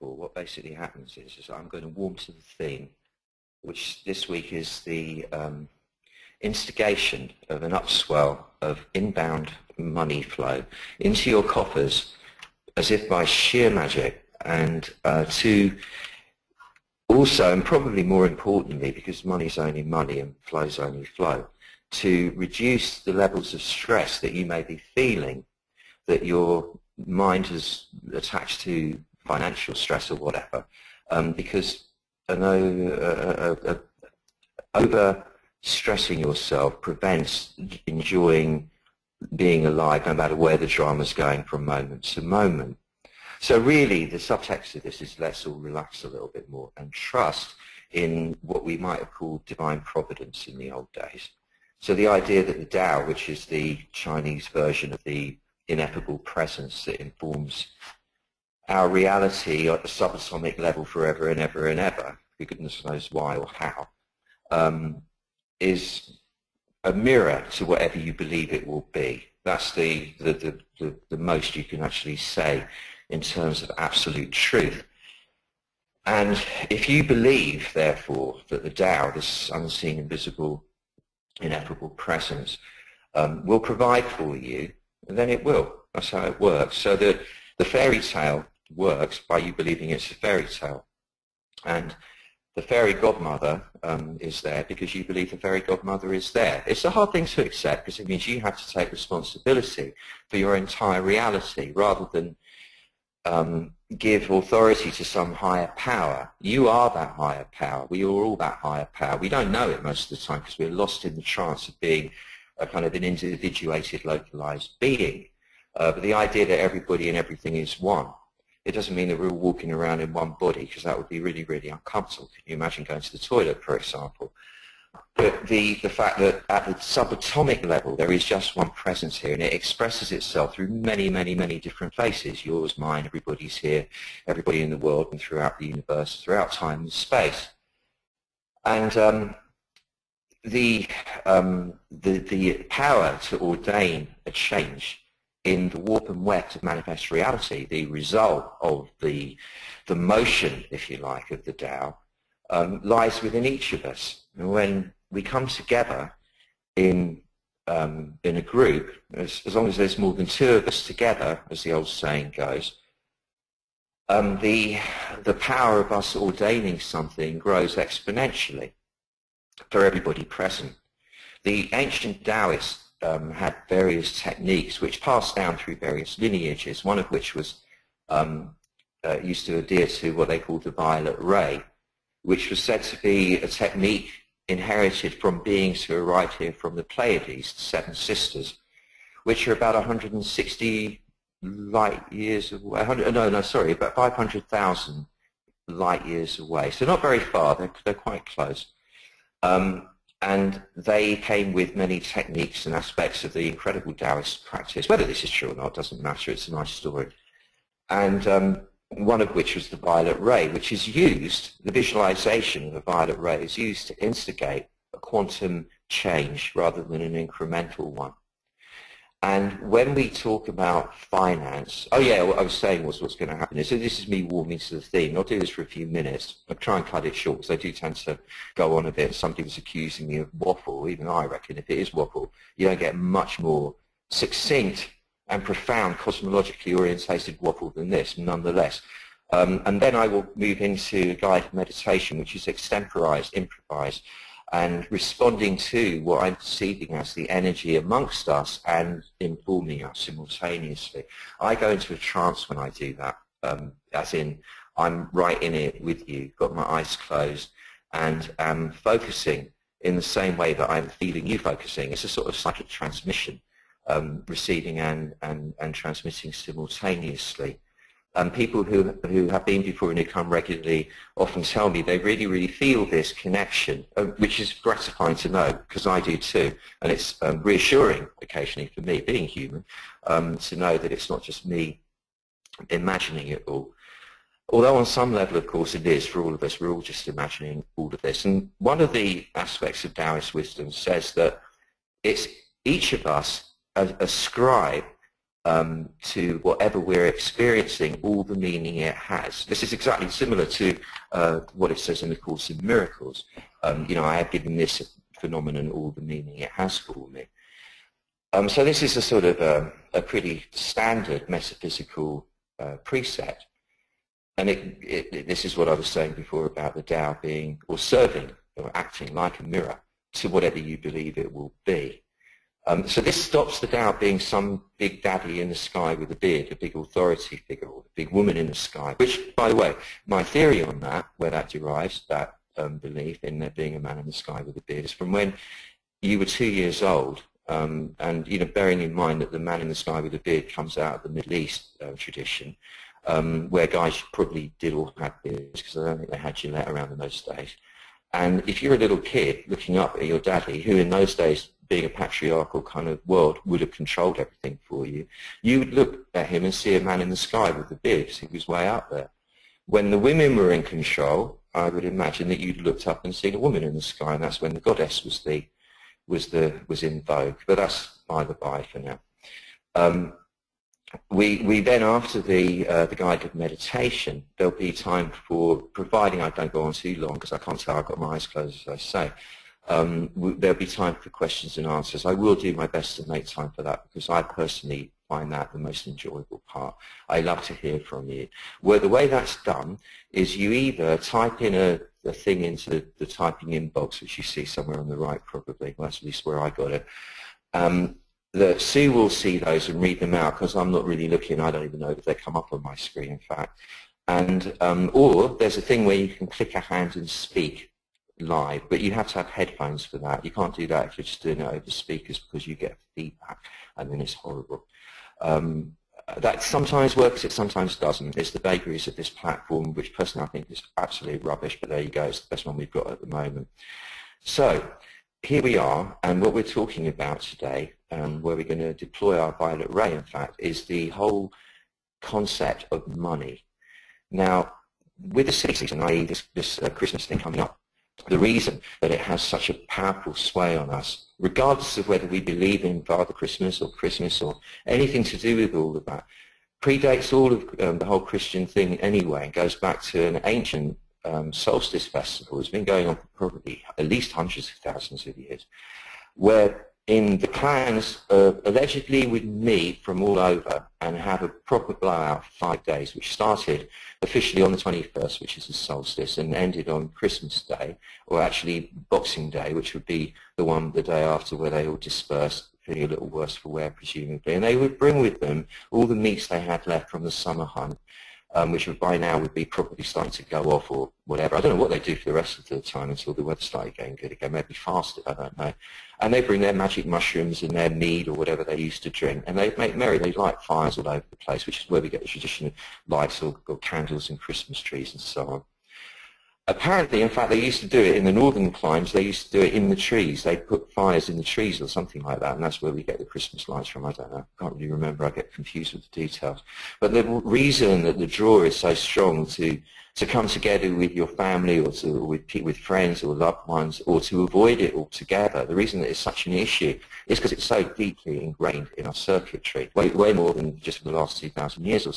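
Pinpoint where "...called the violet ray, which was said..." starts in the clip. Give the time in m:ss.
3:00.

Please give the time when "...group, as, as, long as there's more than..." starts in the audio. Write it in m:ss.
2:38.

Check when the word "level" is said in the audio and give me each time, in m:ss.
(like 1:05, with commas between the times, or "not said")
0:23, 1:00, 2:07, 4:45.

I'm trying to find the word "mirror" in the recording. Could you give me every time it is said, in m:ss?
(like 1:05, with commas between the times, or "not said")
1:06, 5:19.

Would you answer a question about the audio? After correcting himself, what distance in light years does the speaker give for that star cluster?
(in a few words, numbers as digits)
500,000.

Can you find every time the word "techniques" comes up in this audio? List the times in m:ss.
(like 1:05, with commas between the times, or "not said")
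2:54, 3:03, 3:21.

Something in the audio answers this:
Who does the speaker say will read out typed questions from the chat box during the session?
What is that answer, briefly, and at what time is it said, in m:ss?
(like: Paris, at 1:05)
Sue, at 6:38.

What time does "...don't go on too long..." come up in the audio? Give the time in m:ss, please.
6:16.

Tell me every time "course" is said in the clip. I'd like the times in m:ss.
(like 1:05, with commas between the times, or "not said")
4:45, 5:02.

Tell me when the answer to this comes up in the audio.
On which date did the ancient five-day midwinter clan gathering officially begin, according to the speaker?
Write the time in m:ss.
7:44.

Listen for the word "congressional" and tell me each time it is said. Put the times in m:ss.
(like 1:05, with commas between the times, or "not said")
not said.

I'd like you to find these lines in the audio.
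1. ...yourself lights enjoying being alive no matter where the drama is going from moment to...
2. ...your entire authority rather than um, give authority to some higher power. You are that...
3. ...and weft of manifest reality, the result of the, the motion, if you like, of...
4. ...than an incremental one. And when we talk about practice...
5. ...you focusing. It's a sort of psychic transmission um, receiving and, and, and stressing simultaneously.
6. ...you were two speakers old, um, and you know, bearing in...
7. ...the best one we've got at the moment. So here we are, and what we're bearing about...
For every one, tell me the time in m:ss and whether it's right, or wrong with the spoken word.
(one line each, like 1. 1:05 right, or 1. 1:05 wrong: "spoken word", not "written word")
1. 0:36 wrong: "prevents", not "lights"
2. 1:40 wrong: "reality", not "authority"
3. 2:26 right
4. 3:36 wrong: "finance", not "practice"
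5. 4:21 wrong: "transmitting", not "stressing"
6. 5:36 wrong: "years", not "speakers"
7. 7:02 wrong: "talking", not "bearing".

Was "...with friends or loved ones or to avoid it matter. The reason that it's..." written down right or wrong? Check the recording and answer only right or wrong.
wrong.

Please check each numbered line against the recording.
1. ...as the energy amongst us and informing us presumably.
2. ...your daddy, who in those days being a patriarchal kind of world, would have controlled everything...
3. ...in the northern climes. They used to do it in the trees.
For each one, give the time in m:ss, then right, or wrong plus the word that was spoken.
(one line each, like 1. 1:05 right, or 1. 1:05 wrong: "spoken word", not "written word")
1. 4:06 wrong: "simultaneously", not "presumably"
2. 5:50 right
3. 8:17 right.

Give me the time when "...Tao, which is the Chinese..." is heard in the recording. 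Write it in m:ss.
0:52.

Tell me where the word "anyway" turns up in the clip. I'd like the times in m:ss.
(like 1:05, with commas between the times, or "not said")
7:28.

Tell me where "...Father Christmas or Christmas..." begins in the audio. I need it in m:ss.
7:22.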